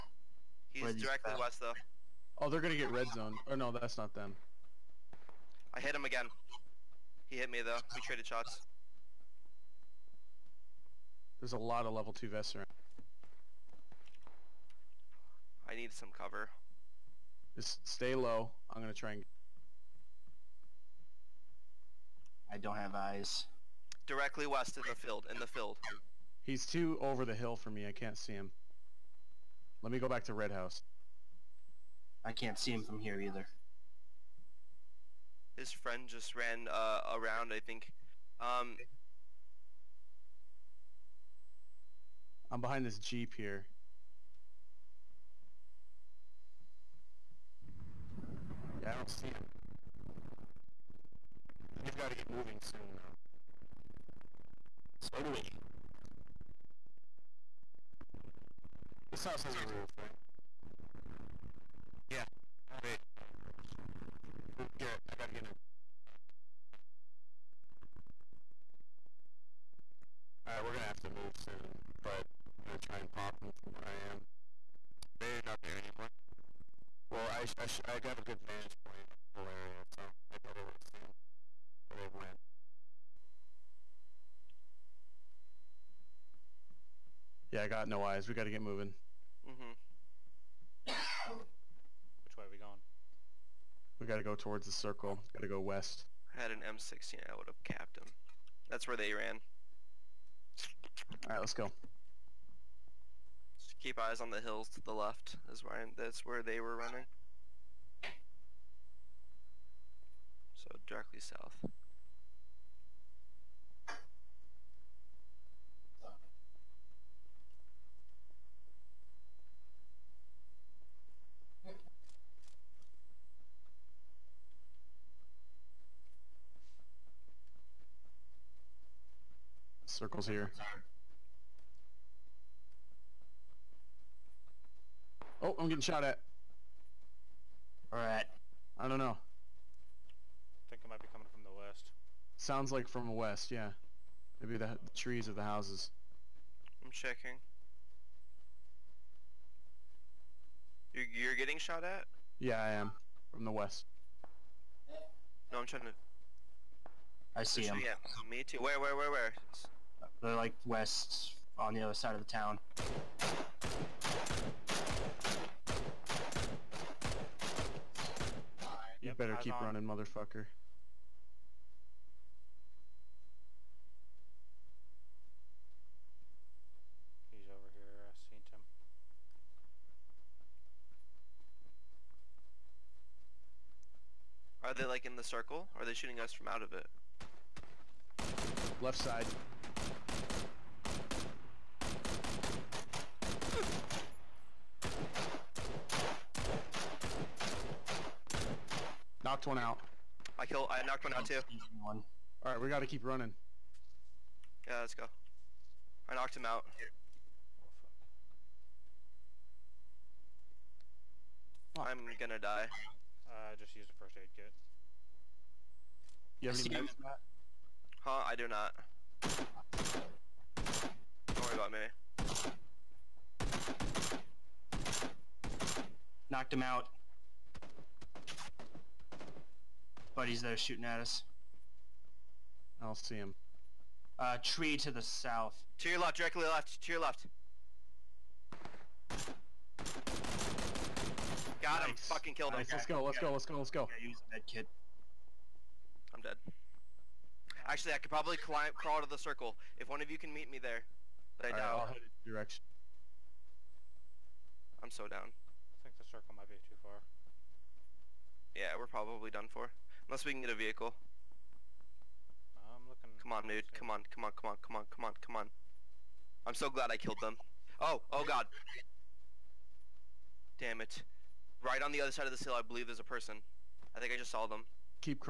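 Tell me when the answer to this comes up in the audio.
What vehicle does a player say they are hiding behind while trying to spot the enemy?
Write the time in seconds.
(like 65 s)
42 s.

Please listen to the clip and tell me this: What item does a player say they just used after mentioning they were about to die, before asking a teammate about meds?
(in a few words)
first aid kit.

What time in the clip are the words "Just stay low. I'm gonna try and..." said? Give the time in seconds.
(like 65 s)
17 s.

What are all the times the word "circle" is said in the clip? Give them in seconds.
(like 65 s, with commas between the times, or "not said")
94 s, 129 s, 185 s, 249 s, 256 s.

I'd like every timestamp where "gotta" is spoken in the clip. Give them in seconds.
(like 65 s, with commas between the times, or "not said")
65 s, 202 s.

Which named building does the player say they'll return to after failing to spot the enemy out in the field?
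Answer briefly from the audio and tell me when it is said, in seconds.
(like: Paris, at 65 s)
Red House, at 30 s.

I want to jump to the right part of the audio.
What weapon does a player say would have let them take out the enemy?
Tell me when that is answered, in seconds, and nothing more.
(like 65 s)
96 s.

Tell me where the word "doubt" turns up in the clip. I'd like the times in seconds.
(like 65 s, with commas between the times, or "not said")
251 s.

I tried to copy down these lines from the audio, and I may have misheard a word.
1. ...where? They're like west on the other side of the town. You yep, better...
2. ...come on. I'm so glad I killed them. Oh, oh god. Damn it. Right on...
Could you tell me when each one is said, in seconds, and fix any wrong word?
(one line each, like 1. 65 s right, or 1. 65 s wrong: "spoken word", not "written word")
1. 159 s right
2. 265 s right.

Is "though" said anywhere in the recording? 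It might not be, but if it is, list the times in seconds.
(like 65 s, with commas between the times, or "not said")
1 s, 7 s, 52 s.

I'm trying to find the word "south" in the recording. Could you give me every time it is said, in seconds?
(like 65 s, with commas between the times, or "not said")
111 s, 234 s.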